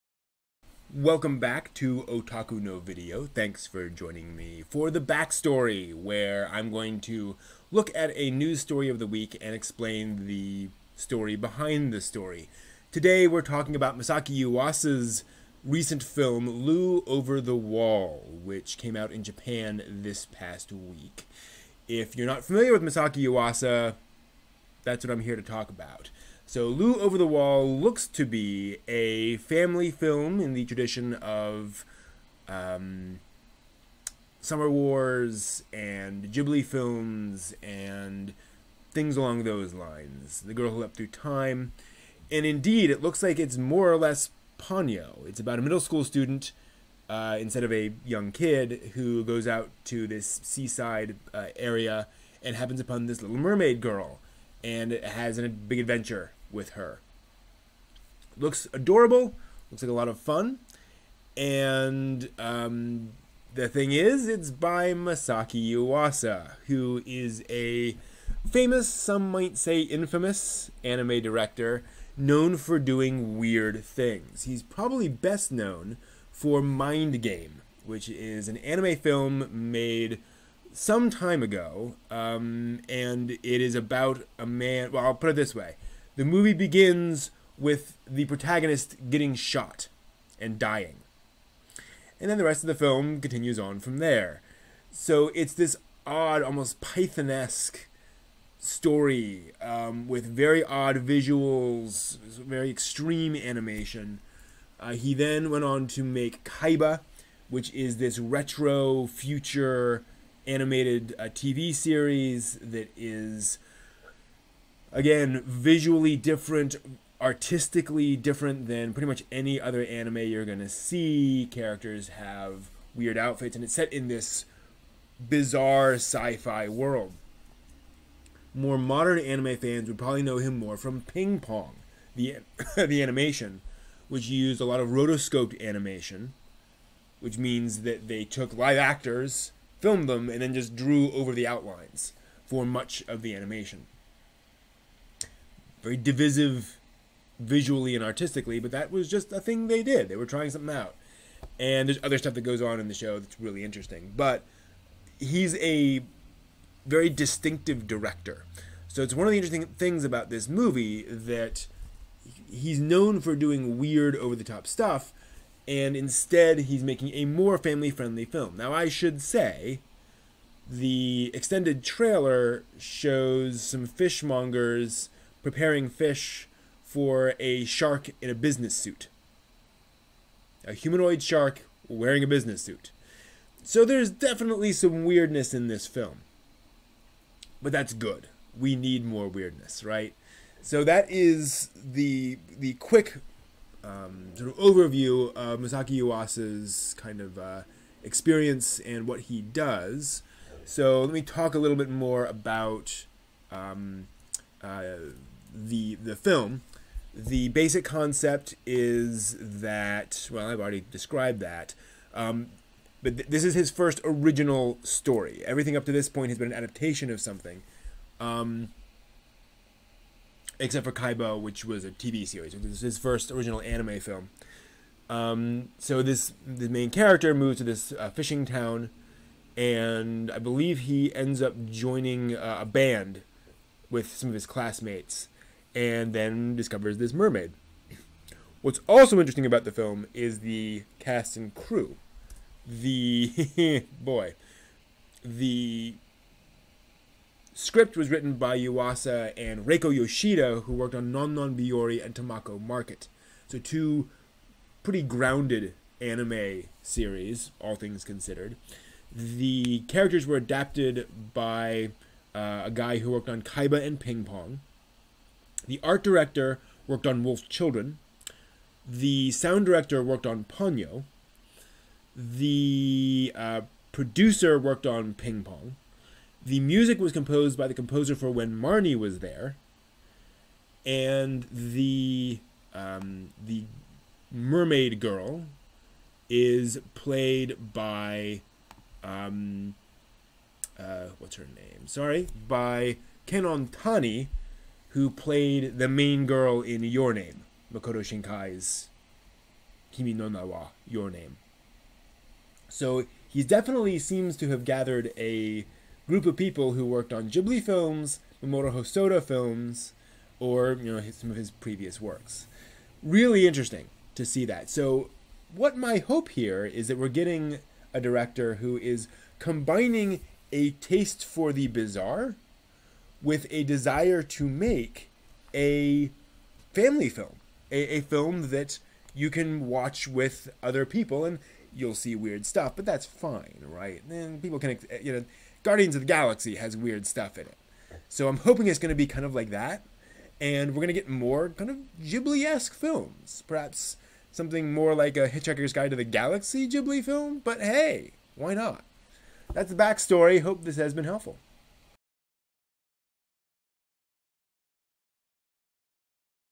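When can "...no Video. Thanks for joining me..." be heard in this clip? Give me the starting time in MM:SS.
00:02.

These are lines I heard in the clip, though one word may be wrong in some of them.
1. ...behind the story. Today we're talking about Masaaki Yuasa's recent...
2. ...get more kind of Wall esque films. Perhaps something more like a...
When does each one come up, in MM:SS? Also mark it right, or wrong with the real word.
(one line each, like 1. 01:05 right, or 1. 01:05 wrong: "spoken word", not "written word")
1. 00:11 right
2. 05:40 wrong: "Ghibli", not "Wall".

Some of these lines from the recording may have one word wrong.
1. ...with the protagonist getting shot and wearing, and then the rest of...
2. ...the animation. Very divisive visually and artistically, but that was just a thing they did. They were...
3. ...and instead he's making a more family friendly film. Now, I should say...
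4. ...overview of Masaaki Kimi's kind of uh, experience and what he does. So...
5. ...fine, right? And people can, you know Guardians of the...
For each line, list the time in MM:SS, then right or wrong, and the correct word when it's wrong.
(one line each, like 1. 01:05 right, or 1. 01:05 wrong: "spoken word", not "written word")
1. 01:27 wrong: "dying", not "wearing"
2. 02:23 right
3. 02:45 right
4. 03:14 wrong: "Yuasa", not "Kimi"
5. 05:33 right.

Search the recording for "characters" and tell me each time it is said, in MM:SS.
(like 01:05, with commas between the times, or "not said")
02:01, 03:46, 04:19.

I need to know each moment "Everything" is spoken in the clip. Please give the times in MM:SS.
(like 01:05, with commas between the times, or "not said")
03:35.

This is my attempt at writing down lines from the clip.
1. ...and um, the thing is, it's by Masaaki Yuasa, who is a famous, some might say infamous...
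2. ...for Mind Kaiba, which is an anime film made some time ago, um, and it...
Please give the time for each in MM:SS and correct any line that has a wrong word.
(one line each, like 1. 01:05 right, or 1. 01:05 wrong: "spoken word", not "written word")
1. 01:01 right
2. 01:16 wrong: "Game", not "Kaiba".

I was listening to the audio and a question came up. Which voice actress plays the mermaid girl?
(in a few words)
Kanon Tani.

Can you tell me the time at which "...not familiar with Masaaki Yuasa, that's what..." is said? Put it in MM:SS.
00:22.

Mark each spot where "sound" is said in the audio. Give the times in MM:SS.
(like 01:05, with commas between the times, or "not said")
04:29.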